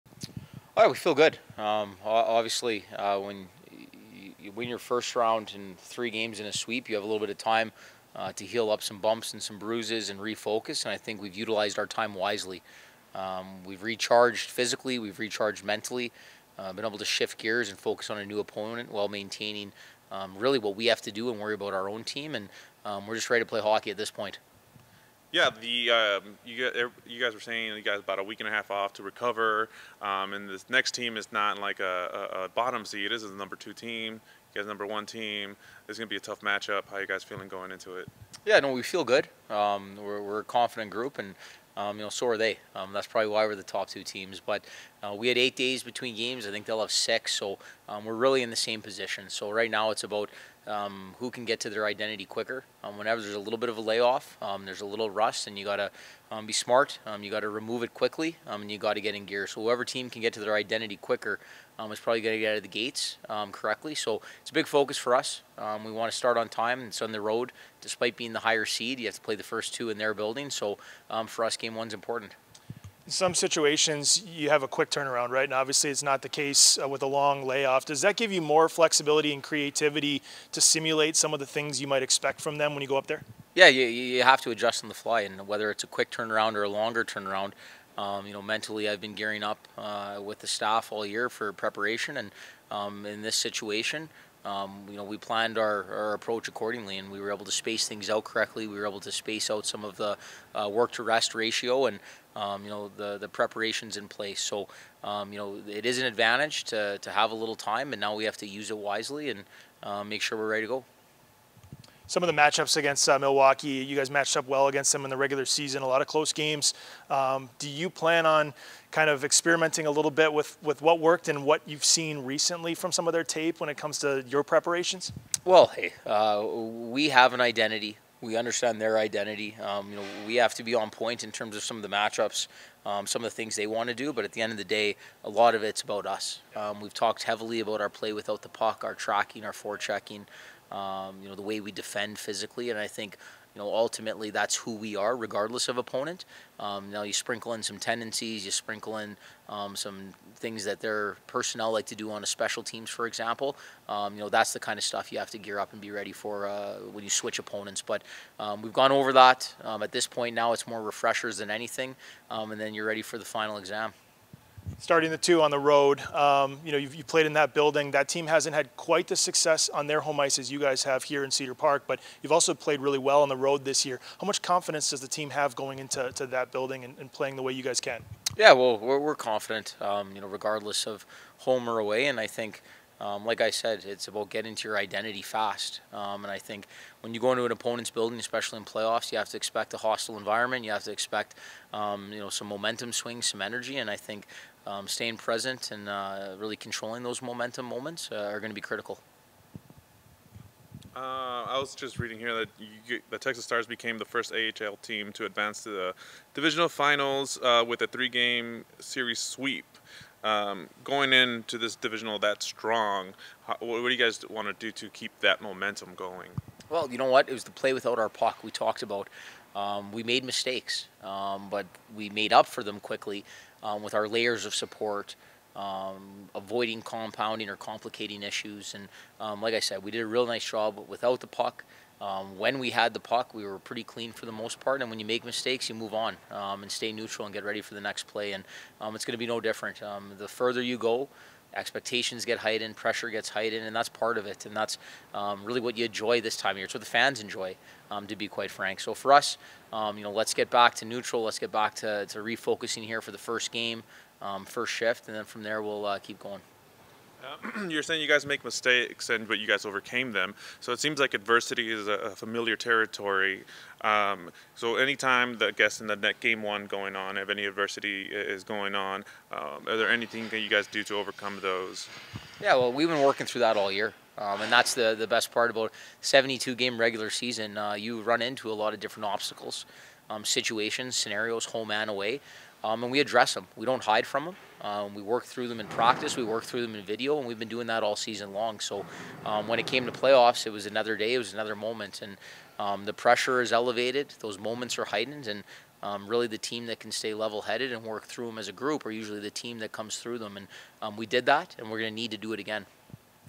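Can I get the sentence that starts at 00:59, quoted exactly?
So whoever team can get to their identity quicker is probably going to get out of the gates correctly.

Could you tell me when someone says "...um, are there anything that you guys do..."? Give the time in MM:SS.
04:29.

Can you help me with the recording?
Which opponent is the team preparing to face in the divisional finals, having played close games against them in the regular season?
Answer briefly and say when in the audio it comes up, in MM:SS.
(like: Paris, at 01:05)
Milwaukee, at 01:53.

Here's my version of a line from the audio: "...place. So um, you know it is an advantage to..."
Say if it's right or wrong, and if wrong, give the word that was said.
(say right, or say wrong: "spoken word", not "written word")
right.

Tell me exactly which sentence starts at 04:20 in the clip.
So it seems like adversity is a, a familiar territory.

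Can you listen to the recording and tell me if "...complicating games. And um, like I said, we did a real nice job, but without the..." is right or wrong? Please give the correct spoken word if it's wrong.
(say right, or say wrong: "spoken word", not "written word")
wrong: "issues", not "games".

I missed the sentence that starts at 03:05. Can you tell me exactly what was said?
Um, and I think when you go into an opponent's building, especially in playoffs, you have to expect a hostile environment.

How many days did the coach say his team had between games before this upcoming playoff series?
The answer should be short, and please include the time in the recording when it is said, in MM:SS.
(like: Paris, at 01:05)
8, at 00:45.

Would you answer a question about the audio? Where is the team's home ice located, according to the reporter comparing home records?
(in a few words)
Cedar Park.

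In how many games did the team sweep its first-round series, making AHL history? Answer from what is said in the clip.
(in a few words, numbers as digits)
3.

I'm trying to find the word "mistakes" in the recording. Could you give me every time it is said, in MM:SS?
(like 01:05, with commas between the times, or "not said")
03:40, 03:55, 04:18.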